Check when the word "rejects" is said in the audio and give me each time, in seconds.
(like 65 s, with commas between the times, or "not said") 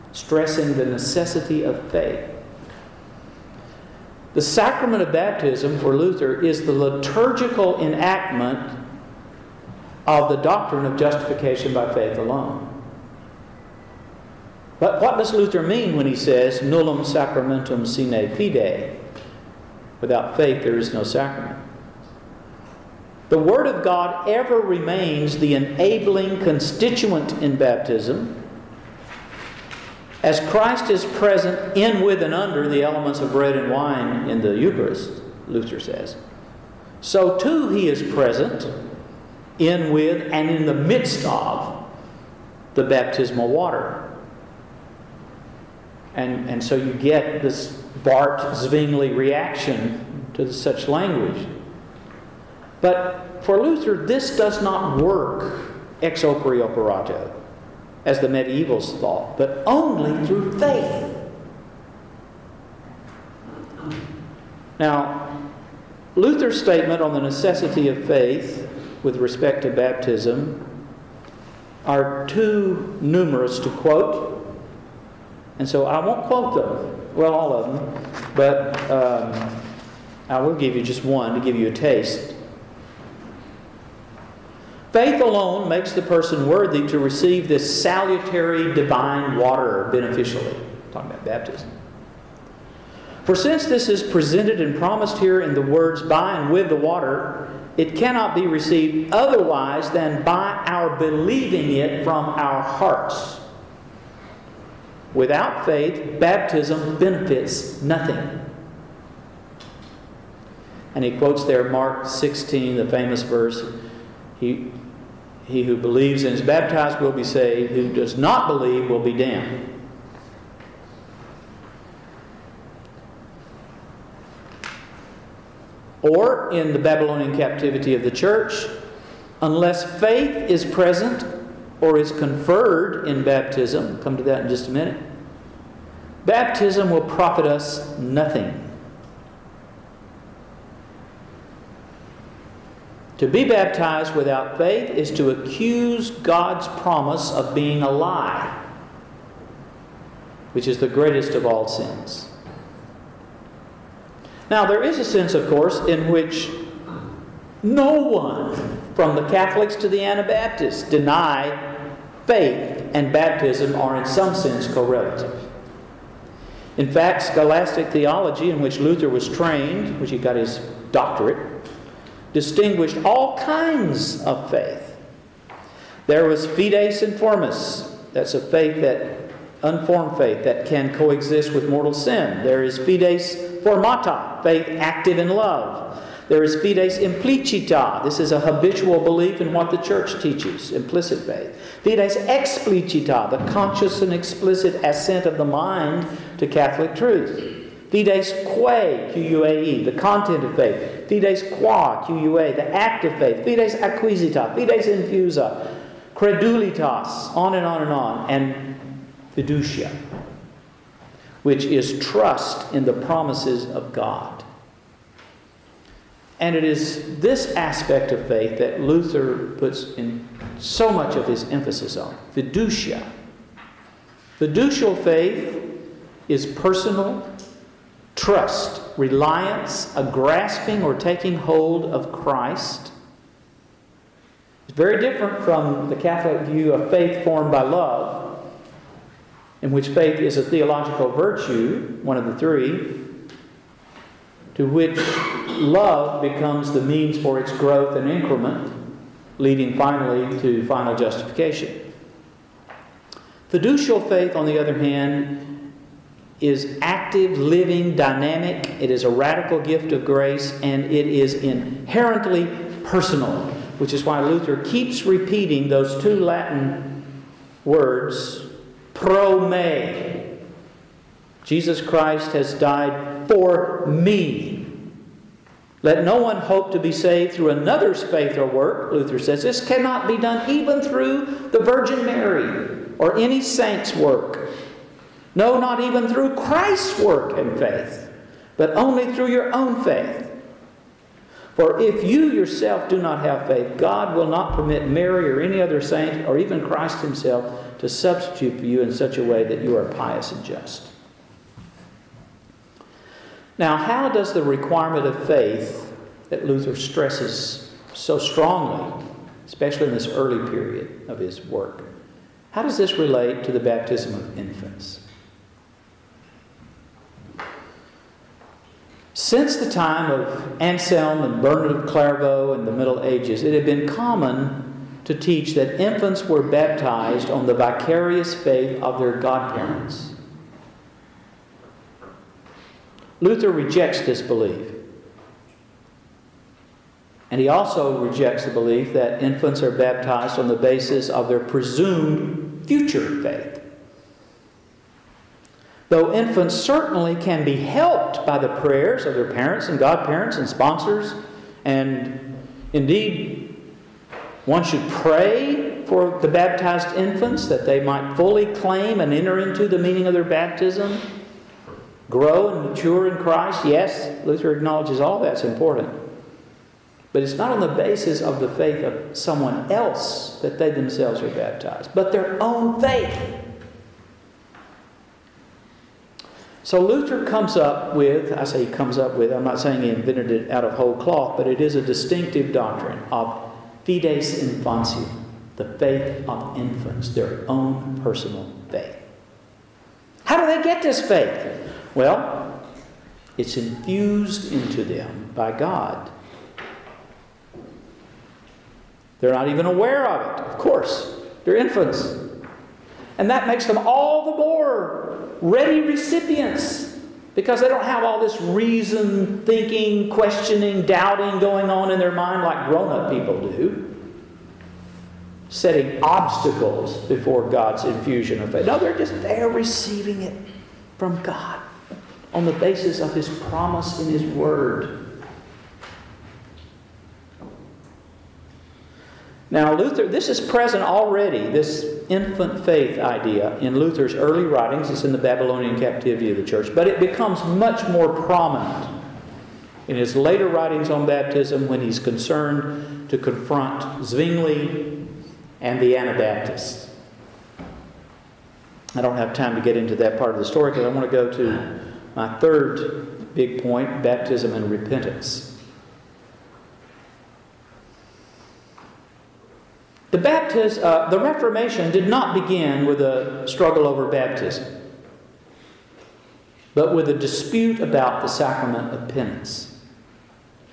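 333 s, 337 s.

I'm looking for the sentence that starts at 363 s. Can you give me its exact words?
Yes, Luther acknowledges all that's important.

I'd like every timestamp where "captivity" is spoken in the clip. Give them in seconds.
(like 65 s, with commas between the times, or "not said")
127 s, 435 s.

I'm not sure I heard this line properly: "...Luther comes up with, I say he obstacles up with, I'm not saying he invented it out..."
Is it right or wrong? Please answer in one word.
wrong.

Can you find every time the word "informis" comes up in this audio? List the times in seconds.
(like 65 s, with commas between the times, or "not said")
177 s.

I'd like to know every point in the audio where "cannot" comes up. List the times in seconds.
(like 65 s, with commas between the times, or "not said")
97 s, 279 s.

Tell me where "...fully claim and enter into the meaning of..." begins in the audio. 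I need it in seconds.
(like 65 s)
358 s.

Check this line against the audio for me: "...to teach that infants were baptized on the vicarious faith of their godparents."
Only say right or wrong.
right.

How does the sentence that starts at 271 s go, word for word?
Jesus Christ has died for me.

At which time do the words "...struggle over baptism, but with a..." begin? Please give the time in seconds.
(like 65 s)
463 s.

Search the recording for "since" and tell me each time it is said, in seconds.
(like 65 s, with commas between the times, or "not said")
93 s, 319 s.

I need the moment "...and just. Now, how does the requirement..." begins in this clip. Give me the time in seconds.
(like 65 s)
300 s.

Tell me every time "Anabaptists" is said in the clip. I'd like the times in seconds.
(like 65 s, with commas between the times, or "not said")
160 s, 445 s.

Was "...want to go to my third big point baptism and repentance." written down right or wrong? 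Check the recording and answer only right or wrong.
right.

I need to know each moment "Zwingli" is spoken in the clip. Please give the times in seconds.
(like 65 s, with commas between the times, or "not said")
48 s, 444 s.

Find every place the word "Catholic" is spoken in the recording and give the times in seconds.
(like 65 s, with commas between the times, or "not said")
159 s, 196 s, 235 s.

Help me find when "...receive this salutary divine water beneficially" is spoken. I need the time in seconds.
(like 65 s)
86 s.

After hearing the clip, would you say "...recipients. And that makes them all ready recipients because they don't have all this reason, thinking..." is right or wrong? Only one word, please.
wrong.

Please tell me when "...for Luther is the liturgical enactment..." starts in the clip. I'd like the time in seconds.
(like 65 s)
5 s.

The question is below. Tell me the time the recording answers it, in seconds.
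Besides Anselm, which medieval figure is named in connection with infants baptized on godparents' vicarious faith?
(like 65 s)
321 s.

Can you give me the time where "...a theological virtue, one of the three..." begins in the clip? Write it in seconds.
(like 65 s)
240 s.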